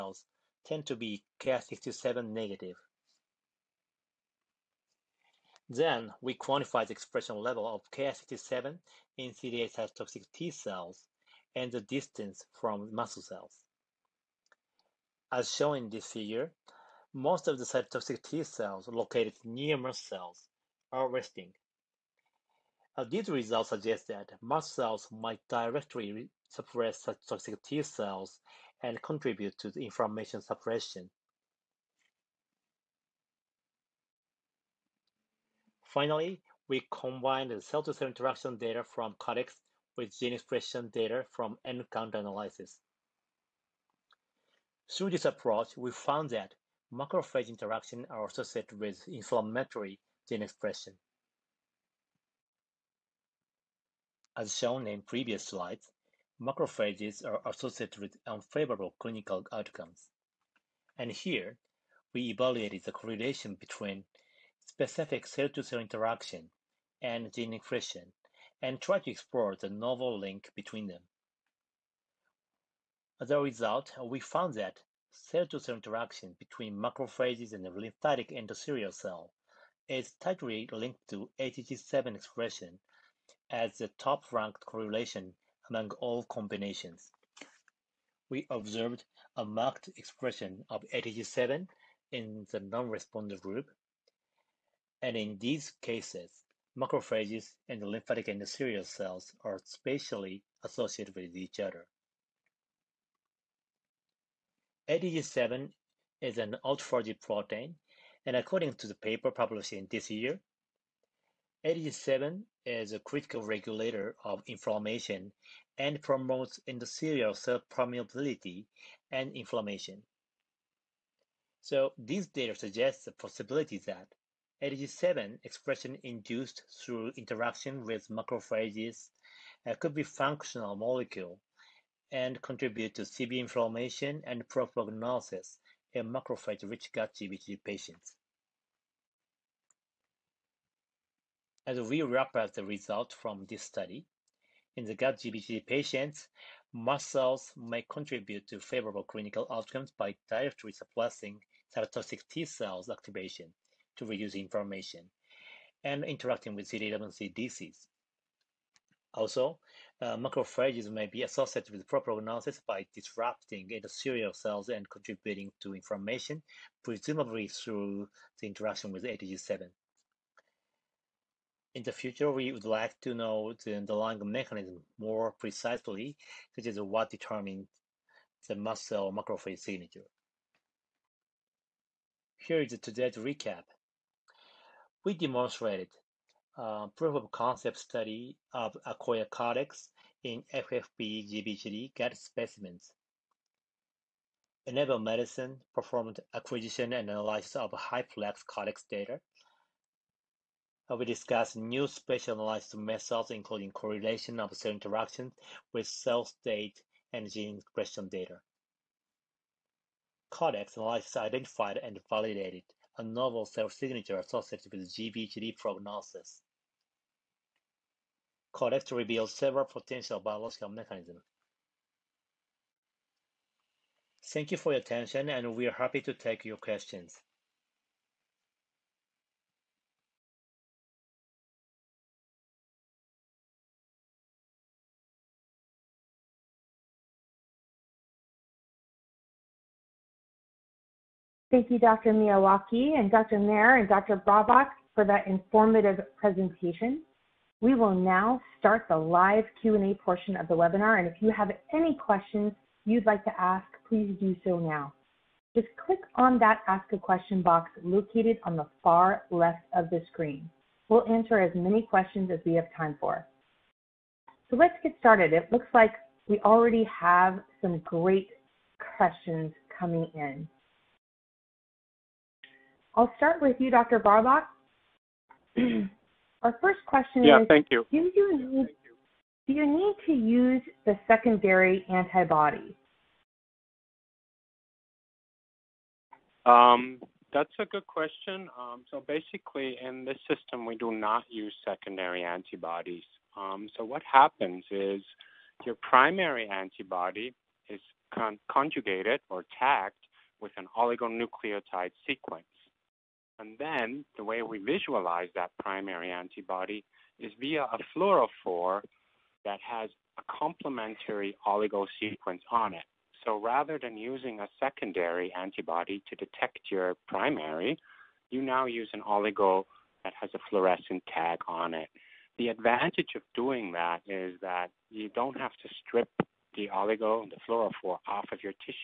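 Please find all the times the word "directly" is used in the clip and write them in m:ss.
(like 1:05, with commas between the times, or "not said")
0:25, 2:30.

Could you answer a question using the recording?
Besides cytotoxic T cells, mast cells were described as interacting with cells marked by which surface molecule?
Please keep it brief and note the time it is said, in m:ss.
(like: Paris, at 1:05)
CD11C, at 2:36.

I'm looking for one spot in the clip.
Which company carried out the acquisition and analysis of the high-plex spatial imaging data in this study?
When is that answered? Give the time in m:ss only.
3:14.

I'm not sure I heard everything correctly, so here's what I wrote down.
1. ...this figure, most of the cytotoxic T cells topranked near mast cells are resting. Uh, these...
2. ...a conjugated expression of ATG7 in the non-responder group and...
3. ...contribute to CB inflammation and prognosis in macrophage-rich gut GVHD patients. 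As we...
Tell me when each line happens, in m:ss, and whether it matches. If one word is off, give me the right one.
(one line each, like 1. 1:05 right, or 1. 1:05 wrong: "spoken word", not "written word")
1. 0:15 wrong: "located", not "topranked"
2. 1:29 wrong: "marked", not "conjugated"
3. 2:12 right.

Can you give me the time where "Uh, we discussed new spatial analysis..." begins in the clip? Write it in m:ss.
3:20.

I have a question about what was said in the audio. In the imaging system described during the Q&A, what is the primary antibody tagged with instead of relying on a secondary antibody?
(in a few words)
oligonucleotide sequence.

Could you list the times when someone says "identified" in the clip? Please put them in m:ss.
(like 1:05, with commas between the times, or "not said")
3:31.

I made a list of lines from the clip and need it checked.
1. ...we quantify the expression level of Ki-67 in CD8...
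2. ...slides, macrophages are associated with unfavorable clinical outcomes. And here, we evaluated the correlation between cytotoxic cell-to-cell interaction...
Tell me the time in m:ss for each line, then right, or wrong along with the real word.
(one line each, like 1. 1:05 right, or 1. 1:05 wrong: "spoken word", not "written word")
1. 0:06 right
2. 0:55 wrong: "specific", not "cytotoxic".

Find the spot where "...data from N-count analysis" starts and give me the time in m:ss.
0:40.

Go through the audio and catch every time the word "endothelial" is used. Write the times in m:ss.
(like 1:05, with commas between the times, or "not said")
1:18, 1:38, 1:56, 2:43.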